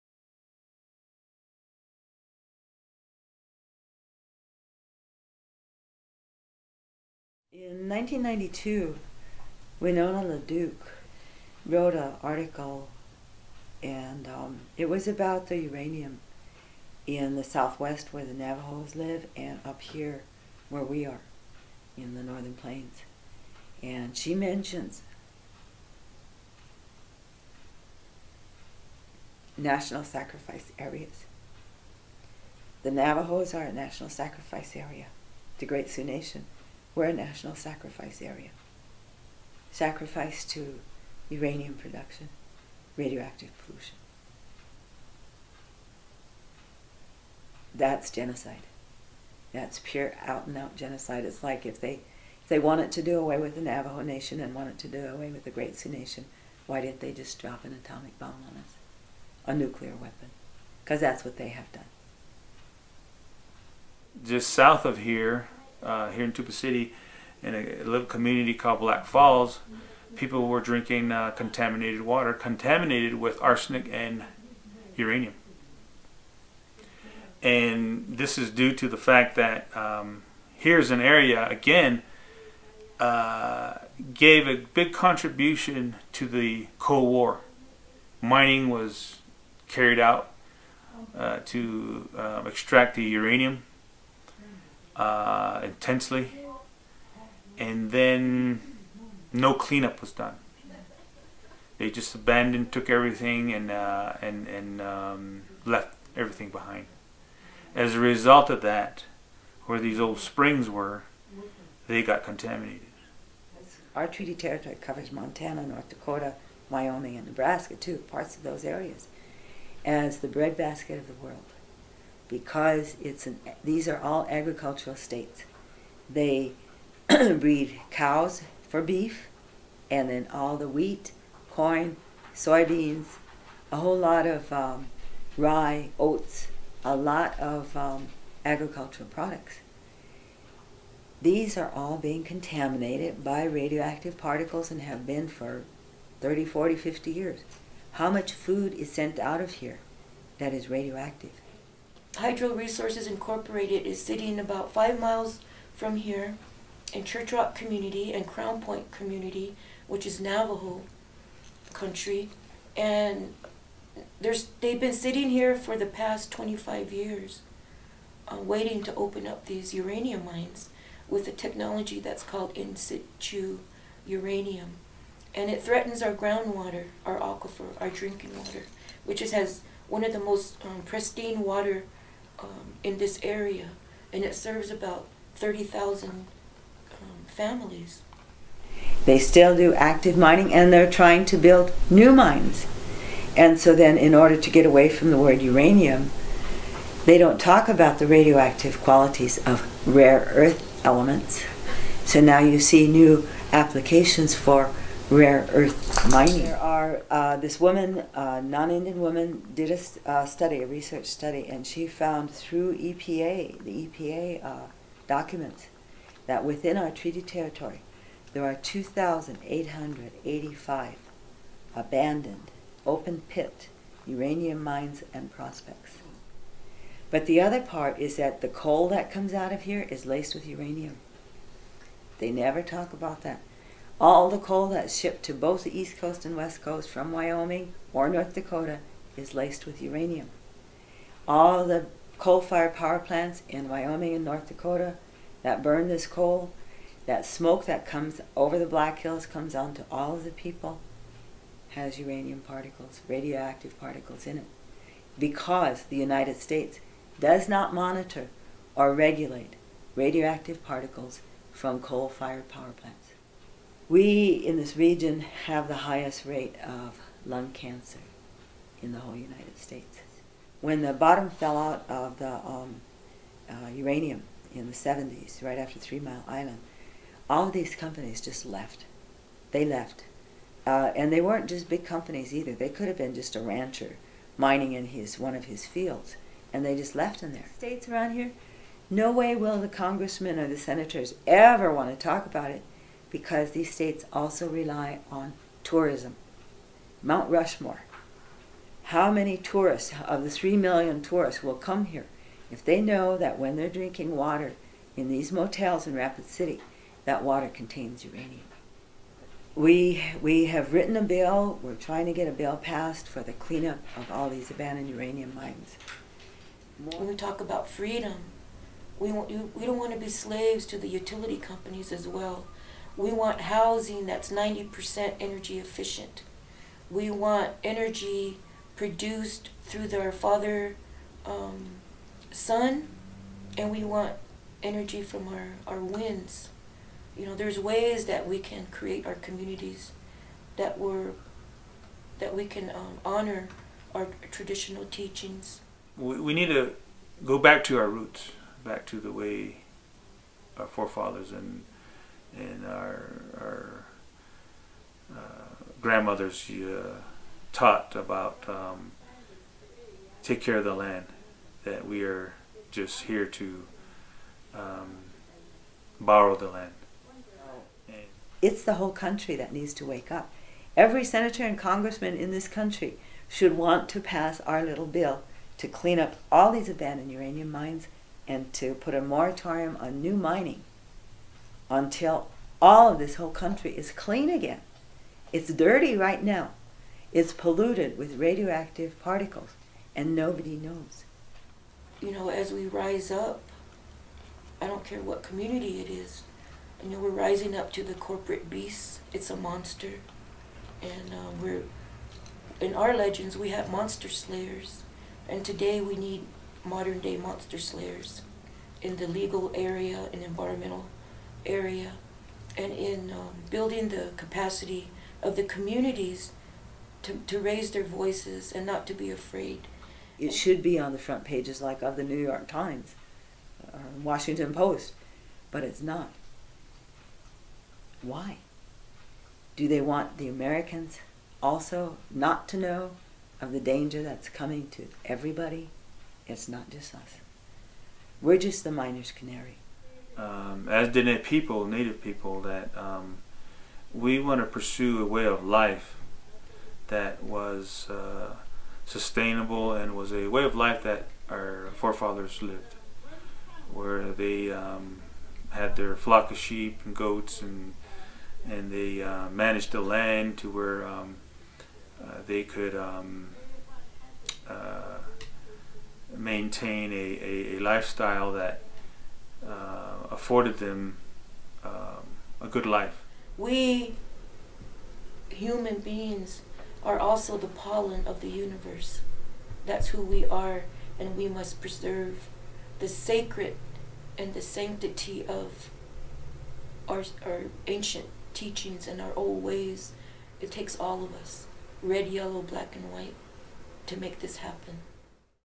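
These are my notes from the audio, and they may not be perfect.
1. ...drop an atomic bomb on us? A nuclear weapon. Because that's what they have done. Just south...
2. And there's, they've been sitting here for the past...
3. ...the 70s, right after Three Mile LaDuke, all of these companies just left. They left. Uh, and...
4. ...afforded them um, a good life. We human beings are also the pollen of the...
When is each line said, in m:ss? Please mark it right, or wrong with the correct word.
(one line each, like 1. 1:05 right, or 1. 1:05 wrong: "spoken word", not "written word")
1. 0:57 right
2. 2:42 right
3. 4:34 wrong: "Island", not "LaDuke"
4. 7:50 right.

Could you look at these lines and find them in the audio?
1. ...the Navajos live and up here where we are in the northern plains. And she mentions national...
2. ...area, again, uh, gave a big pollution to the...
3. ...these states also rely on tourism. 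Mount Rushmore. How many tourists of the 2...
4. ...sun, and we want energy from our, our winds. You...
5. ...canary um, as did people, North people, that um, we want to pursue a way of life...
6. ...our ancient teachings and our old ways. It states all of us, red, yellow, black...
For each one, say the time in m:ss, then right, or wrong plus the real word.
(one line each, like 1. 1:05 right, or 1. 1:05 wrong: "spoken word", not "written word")
1. 0:18 right
2. 1:21 wrong: "contribution", not "pollution"
3. 4:53 wrong: "3", not "2"
4. 5:32 right
5. 7:19 wrong: "Native", not "North"
6. 8:07 wrong: "takes", not "states".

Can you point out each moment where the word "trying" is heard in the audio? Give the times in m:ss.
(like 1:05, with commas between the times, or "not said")
3:10, 5:11.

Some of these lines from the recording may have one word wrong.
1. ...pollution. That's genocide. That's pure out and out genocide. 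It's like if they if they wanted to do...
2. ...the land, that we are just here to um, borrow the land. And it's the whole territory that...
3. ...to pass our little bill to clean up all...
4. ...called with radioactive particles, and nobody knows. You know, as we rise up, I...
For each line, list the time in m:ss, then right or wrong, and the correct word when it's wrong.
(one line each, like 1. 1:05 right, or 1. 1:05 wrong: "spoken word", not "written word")
1. 0:43 right
2. 6:00 wrong: "country", not "territory"
3. 6:13 right
4. 6:27 wrong: "polluted", not "called".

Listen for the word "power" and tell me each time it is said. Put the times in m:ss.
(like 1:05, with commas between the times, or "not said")
4:02, 4:22.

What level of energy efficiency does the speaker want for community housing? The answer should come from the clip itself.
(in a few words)
90%.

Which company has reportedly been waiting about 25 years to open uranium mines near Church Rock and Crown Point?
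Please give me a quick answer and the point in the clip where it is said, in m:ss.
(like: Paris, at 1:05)
Hydro Resources Incorporated, at 2:32.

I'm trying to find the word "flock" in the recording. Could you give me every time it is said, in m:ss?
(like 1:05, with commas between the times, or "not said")
7:35.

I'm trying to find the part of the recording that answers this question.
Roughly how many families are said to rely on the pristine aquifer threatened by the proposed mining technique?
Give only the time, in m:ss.
3:05.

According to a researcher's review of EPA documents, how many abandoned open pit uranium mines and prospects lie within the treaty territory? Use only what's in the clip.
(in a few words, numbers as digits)
2,885.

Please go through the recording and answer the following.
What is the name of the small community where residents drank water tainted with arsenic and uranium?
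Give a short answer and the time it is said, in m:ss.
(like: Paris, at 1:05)
Black Falls, at 1:08.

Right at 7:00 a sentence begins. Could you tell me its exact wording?
It should be on the front pages like of the New York Times or uh, Washington Post, but it's not.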